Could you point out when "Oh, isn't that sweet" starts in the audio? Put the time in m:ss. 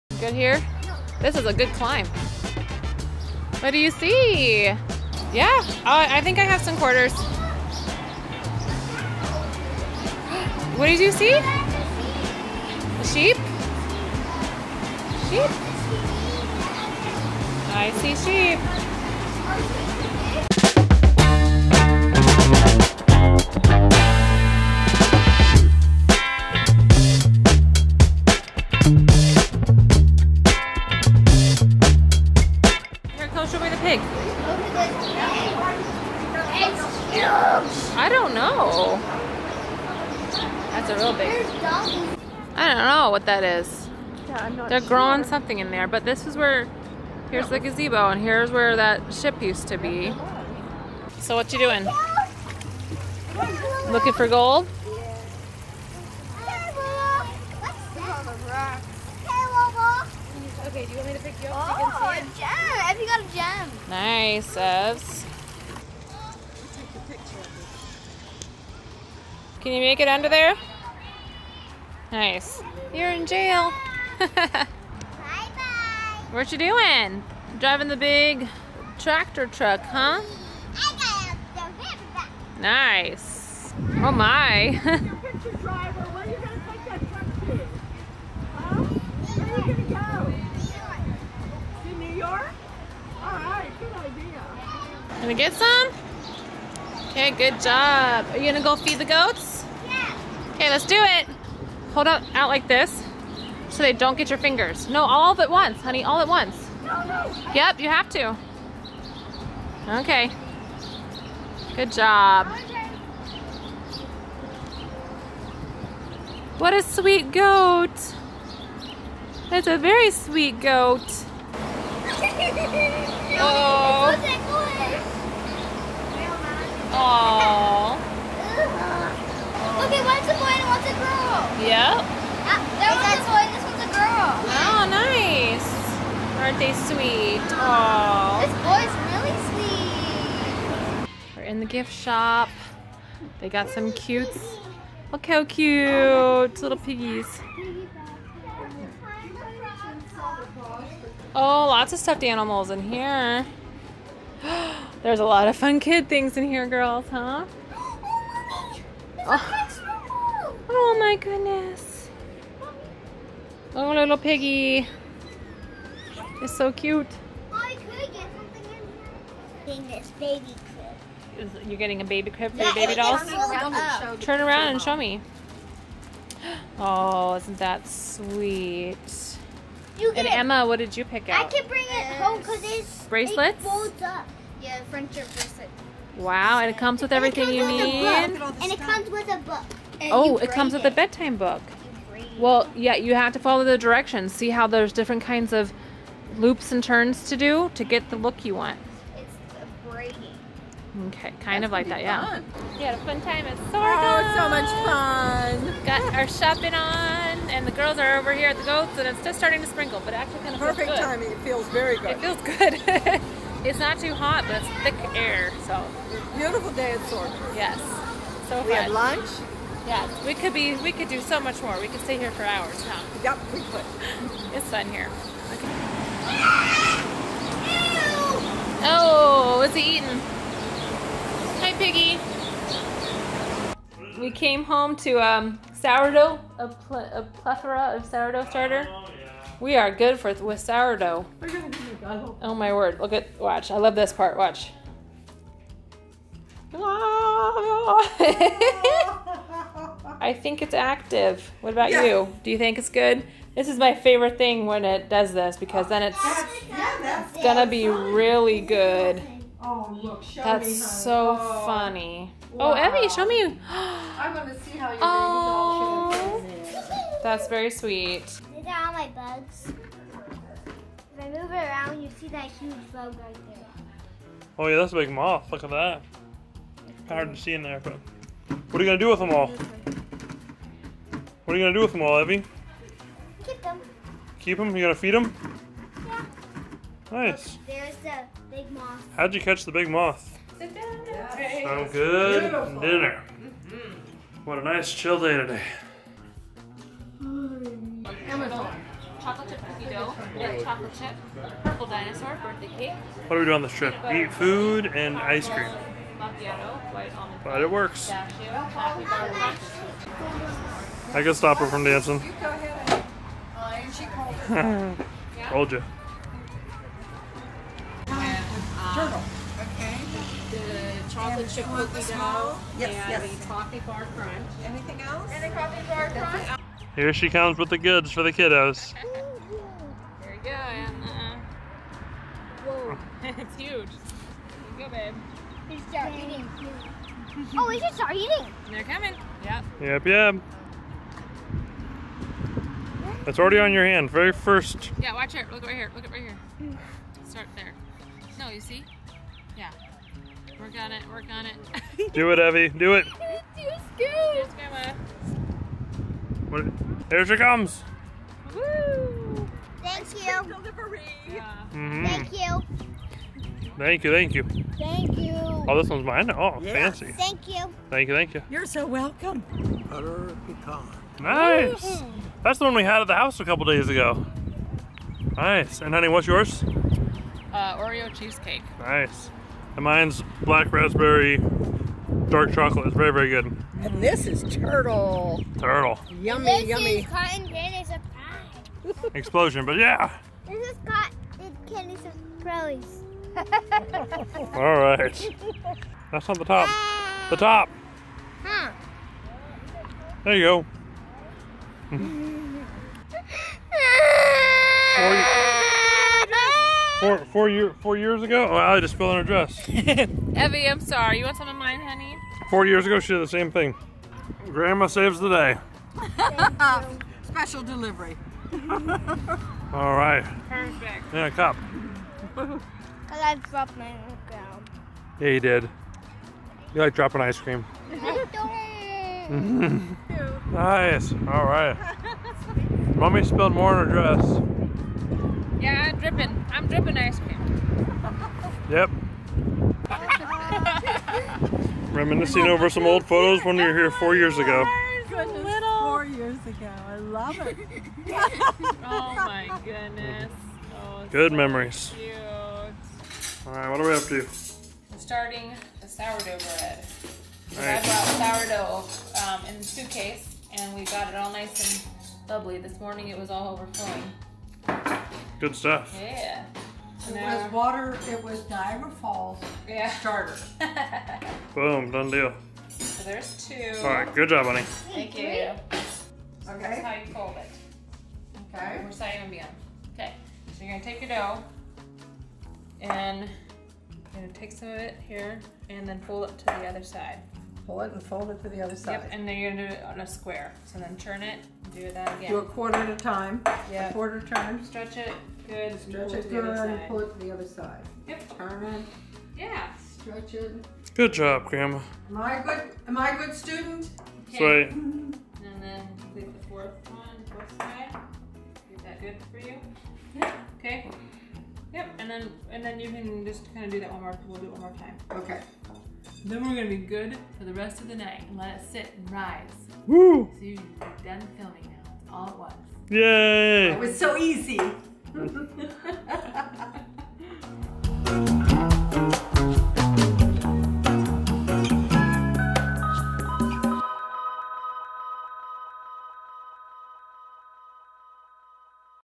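2:56.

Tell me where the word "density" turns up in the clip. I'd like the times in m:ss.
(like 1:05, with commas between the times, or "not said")
not said.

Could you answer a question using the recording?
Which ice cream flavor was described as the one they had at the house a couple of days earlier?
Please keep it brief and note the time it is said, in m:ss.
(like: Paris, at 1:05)
Butter pecan, at 6:09.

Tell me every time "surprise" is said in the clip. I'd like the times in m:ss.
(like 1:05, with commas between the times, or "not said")
6:27, 6:31.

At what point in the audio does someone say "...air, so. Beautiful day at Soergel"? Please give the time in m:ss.
3:35.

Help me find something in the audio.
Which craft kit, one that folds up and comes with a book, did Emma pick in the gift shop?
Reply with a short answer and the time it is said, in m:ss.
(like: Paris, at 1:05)
Friendship bracelet, at 3:04.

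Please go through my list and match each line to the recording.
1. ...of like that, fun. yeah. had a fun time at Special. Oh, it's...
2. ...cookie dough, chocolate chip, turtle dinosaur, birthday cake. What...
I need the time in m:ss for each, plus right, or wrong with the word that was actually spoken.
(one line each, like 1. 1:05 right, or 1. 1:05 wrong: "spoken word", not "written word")
1. 3:21 wrong: "Soergel", not "Special"
2. 4:59 wrong: "purple", not "turtle".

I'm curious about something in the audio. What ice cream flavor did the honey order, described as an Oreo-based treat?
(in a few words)
Oreo cheesecake.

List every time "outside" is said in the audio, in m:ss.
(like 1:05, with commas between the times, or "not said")
not said.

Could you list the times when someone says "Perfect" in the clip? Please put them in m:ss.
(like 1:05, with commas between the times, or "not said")
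3:30, 7:00.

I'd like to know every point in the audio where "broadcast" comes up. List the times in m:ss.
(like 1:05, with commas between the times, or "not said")
not said.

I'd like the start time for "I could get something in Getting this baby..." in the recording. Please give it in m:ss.
2:47.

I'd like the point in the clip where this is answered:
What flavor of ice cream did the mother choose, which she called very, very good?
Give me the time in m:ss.
6:20.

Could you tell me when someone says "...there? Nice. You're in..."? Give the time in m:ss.
1:10.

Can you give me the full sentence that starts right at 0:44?
Yeah, They're growing something in there, but this is where, here's the gazebo, and here's where that ship used to be.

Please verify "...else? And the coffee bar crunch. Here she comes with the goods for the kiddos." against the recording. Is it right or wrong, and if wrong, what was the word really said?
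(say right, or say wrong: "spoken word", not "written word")
right.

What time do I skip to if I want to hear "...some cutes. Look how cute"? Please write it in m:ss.
2:23.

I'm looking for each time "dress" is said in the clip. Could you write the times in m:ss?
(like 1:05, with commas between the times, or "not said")
6:49, 7:13.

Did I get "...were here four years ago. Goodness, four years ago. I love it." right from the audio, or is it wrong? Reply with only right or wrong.
right.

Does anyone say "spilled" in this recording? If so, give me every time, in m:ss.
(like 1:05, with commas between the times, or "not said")
6:48, 7:13.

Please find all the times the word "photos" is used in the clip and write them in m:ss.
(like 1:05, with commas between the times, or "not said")
7:23.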